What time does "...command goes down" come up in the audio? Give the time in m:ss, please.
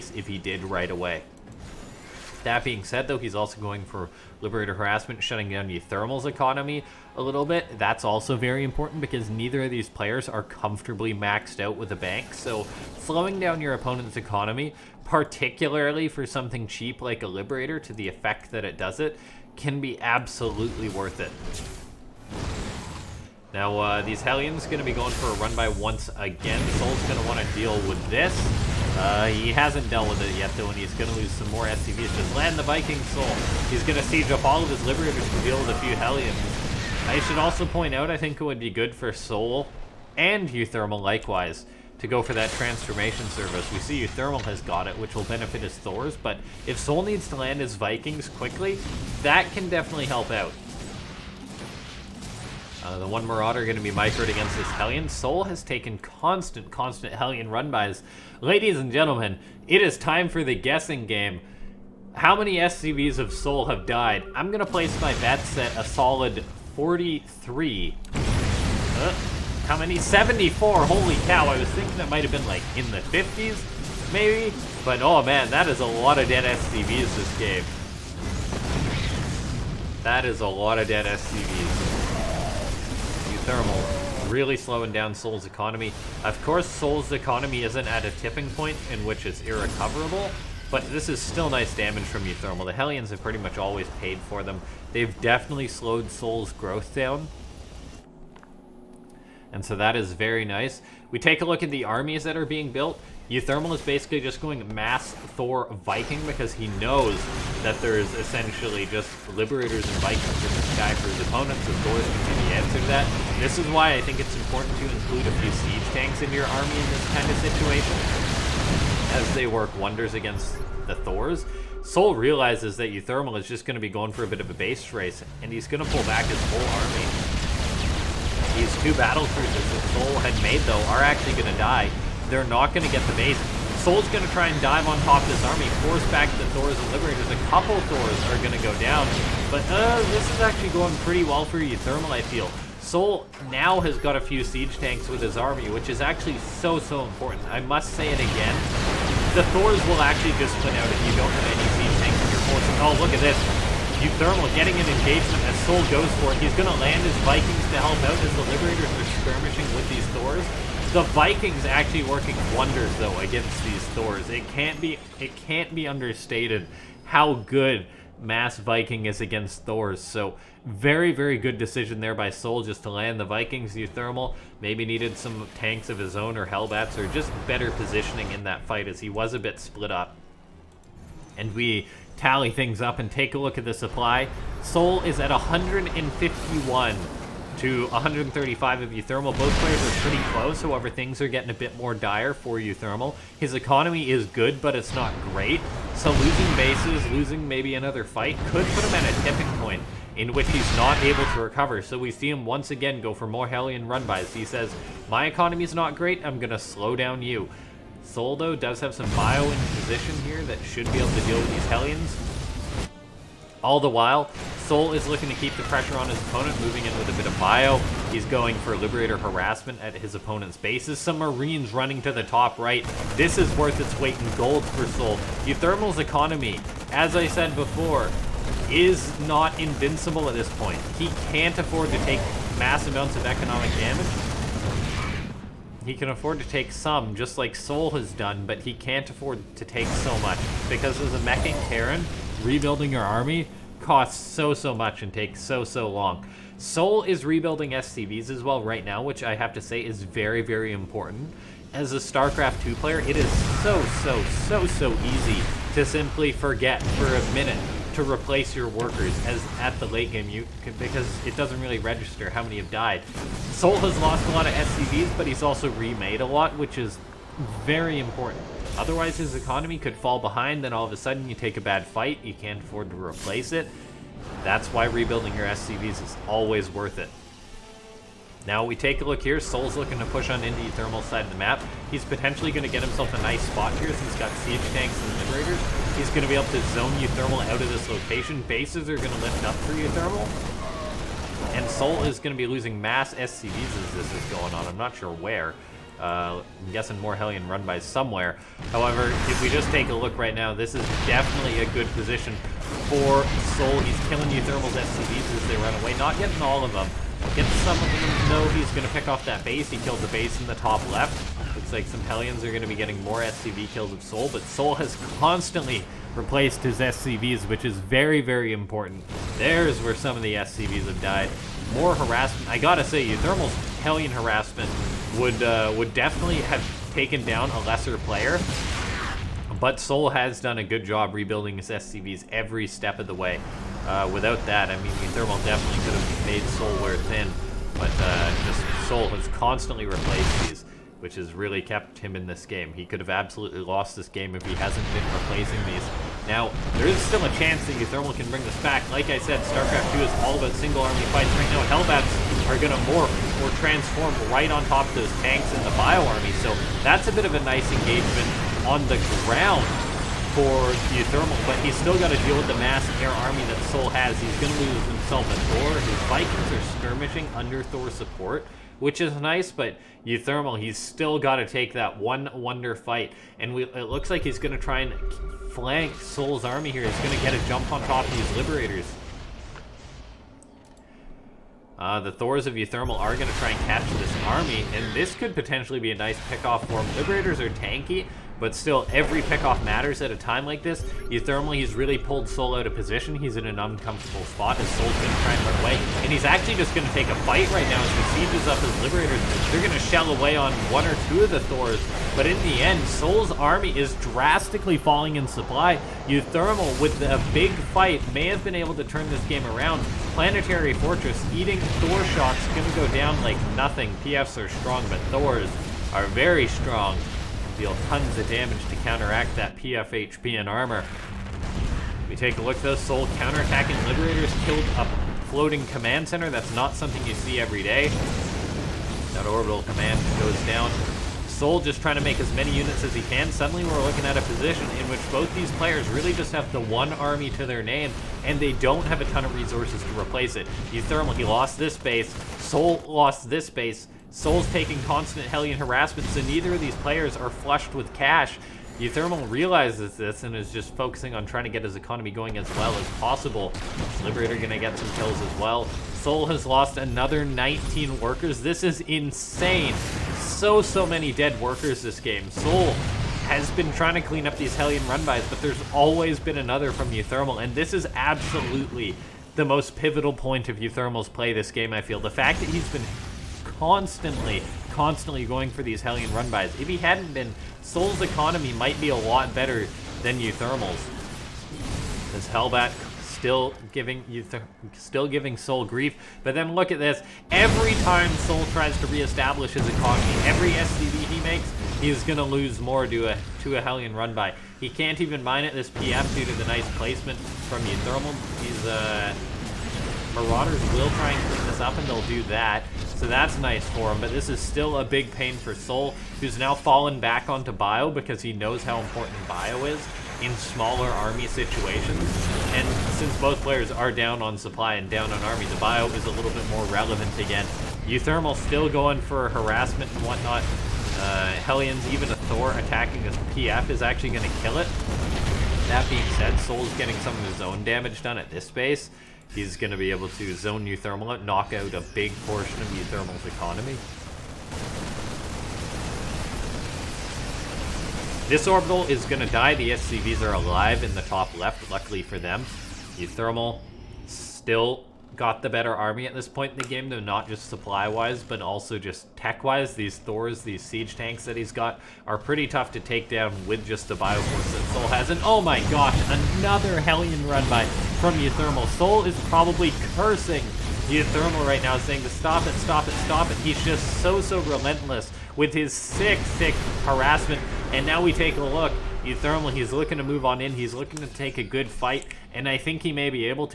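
7:09.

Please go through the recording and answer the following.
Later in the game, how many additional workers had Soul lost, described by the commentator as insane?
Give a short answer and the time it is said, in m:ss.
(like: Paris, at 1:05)
19, at 7:37.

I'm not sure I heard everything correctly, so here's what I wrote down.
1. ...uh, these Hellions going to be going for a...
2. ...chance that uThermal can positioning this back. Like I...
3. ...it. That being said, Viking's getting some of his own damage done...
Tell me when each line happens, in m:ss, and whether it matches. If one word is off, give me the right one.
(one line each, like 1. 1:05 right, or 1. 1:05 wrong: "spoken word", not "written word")
1. 0:23 right
2. 5:47 wrong: "bring", not "positioning"
3. 8:44 wrong: "Soul", not "Viking".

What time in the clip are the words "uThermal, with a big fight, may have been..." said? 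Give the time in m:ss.
6:46.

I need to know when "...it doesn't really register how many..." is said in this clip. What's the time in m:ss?
4:21.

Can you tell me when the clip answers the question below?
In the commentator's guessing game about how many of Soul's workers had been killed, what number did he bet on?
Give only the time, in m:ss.
1:06.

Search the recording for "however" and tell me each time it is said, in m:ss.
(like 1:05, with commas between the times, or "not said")
3:10, 4:58.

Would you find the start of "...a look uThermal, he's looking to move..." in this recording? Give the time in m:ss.
9:28.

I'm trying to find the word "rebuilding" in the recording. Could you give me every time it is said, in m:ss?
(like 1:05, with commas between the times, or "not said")
4:02, 4:07, 4:34, 5:31.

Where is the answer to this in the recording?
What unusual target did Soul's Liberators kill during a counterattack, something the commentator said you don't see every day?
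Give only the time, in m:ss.
7:05.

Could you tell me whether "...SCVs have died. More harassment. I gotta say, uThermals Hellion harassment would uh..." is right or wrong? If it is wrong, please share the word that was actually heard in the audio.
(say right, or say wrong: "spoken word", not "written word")
right.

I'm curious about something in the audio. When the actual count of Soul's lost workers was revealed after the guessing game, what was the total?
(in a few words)
74.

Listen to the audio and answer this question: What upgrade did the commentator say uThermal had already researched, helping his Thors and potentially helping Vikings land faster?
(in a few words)
Transformation servos.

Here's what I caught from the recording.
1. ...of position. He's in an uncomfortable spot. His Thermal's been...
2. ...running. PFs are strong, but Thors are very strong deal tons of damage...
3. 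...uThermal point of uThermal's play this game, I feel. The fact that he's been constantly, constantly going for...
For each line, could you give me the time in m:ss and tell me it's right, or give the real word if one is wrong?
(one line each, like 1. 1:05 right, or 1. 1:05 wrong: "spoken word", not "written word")
1. 6:32 wrong: "Soul", not "Thermal"
2. 6:53 wrong: "nothing", not "running"
3. 7:49 wrong: "pivotal", not "uThermal".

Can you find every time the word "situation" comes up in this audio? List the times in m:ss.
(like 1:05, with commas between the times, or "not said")
1:57, 8:31.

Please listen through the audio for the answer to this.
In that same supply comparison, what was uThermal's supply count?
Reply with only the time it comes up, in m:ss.
3:07.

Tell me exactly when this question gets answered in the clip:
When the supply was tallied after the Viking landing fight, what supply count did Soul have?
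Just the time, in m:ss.
3:05.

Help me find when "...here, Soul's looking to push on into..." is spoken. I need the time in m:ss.
4:39.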